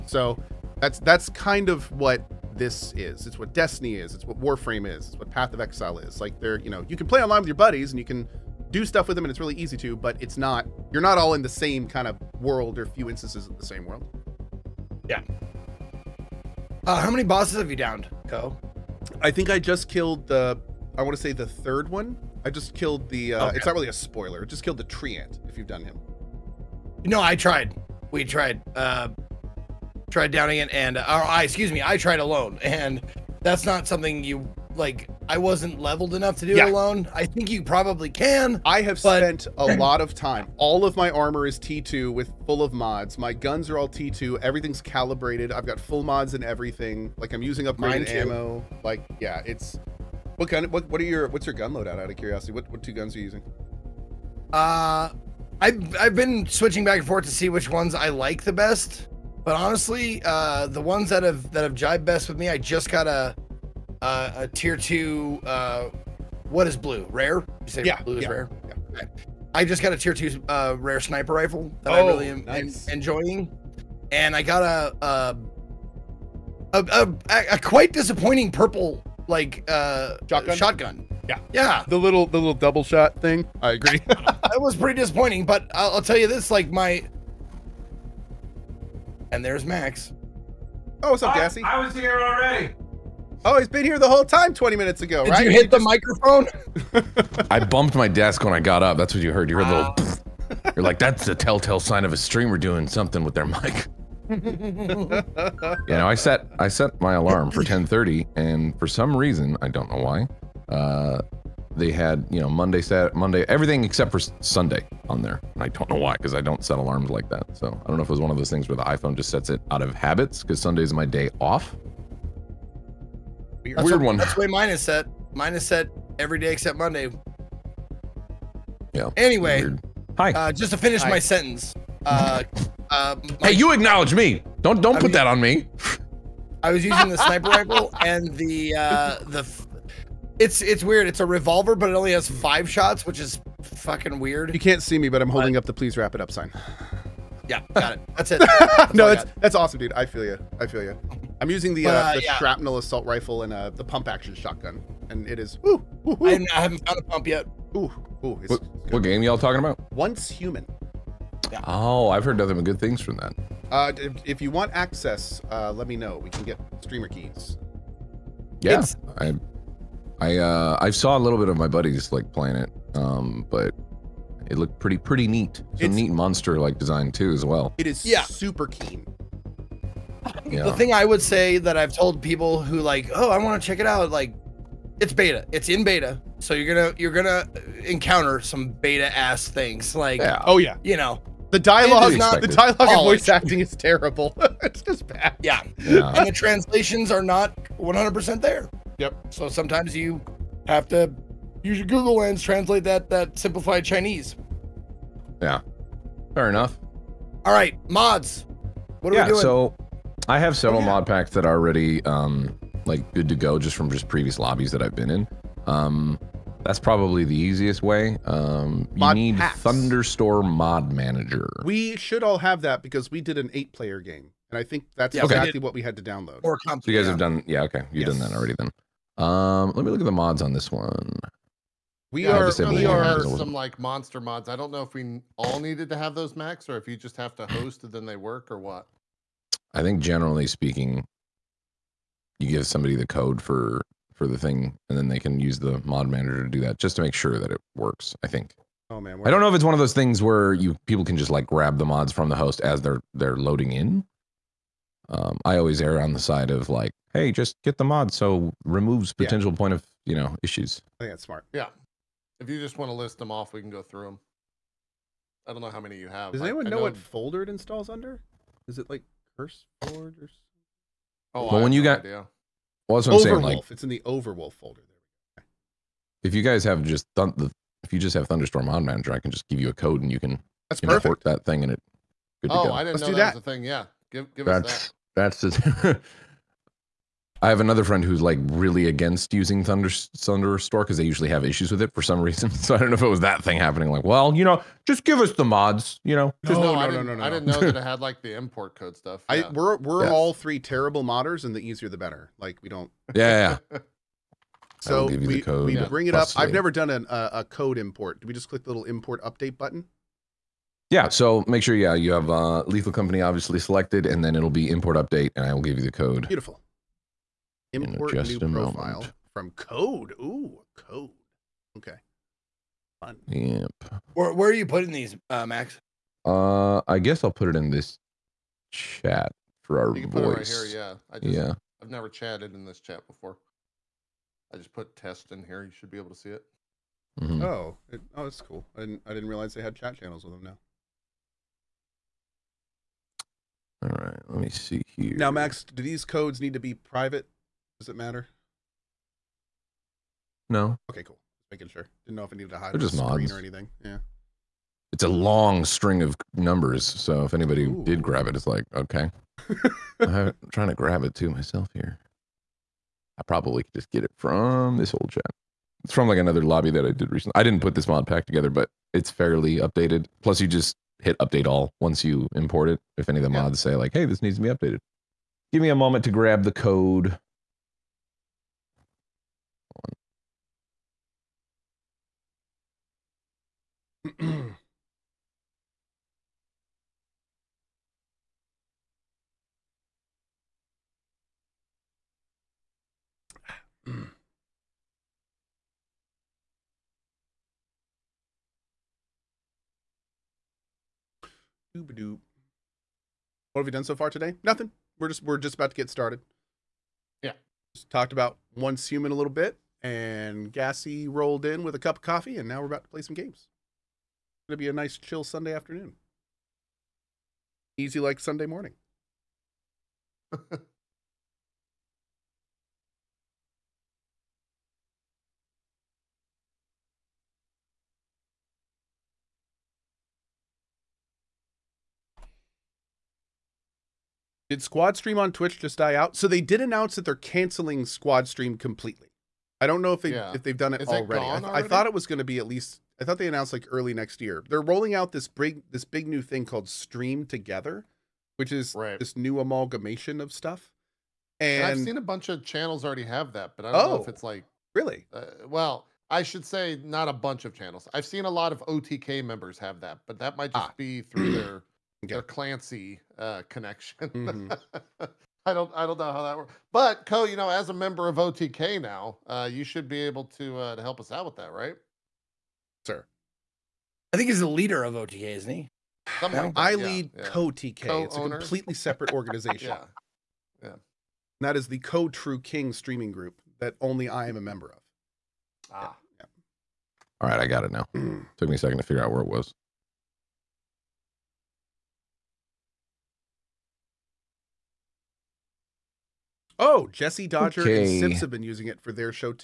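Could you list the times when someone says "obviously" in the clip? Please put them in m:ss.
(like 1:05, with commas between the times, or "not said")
5:13.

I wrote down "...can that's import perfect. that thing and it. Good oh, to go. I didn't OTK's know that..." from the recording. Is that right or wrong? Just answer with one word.
wrong.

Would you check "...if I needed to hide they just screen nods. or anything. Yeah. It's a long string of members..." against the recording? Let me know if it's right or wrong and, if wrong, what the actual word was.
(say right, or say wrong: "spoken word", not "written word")
wrong: "numbers", not "members".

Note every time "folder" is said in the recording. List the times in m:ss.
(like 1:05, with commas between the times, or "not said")
4:26, 4:34.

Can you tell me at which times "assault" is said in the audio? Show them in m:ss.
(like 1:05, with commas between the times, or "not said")
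2:32.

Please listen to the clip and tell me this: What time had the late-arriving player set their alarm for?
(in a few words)
10:30.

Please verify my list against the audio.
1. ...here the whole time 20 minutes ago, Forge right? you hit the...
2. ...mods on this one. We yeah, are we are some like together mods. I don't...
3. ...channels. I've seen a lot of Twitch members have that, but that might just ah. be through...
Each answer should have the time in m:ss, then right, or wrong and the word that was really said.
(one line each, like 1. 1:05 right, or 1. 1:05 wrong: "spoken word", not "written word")
1. 1:33 wrong: "Did", not "Forge"
2. 3:50 wrong: "monster", not "together"
3. 7:37 wrong: "OTK", not "Twitch".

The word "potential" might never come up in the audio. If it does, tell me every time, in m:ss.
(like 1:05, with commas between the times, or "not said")
4:19.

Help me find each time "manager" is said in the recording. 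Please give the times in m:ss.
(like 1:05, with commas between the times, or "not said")
3:40, 4:06, 4:38.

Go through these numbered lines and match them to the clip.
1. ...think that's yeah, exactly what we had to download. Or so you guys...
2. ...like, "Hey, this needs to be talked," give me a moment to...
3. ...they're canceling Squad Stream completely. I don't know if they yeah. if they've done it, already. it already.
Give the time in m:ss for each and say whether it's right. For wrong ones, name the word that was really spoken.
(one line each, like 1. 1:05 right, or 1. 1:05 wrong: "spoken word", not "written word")
1. 3:44 right
2. 6:13 wrong: "updated", not "talked"
3. 7:17 right.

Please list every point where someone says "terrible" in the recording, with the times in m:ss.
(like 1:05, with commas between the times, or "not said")
3:13, 5:00.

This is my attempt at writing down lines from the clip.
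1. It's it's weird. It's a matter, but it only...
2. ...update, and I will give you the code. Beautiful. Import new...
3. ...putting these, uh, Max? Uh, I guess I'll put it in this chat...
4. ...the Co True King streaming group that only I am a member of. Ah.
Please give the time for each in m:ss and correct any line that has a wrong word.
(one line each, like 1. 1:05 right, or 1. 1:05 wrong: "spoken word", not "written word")
1. 2:20 wrong: "revolver", not "matter"
2. 5:14 right
3. 5:24 right
4. 8:01 right.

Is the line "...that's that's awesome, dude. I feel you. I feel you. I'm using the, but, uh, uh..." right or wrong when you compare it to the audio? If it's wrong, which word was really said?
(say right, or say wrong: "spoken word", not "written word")
right.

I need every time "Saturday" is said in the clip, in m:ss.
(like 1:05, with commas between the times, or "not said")
1:52.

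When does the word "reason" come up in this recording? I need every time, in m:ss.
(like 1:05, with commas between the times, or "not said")
1:49, 4:52.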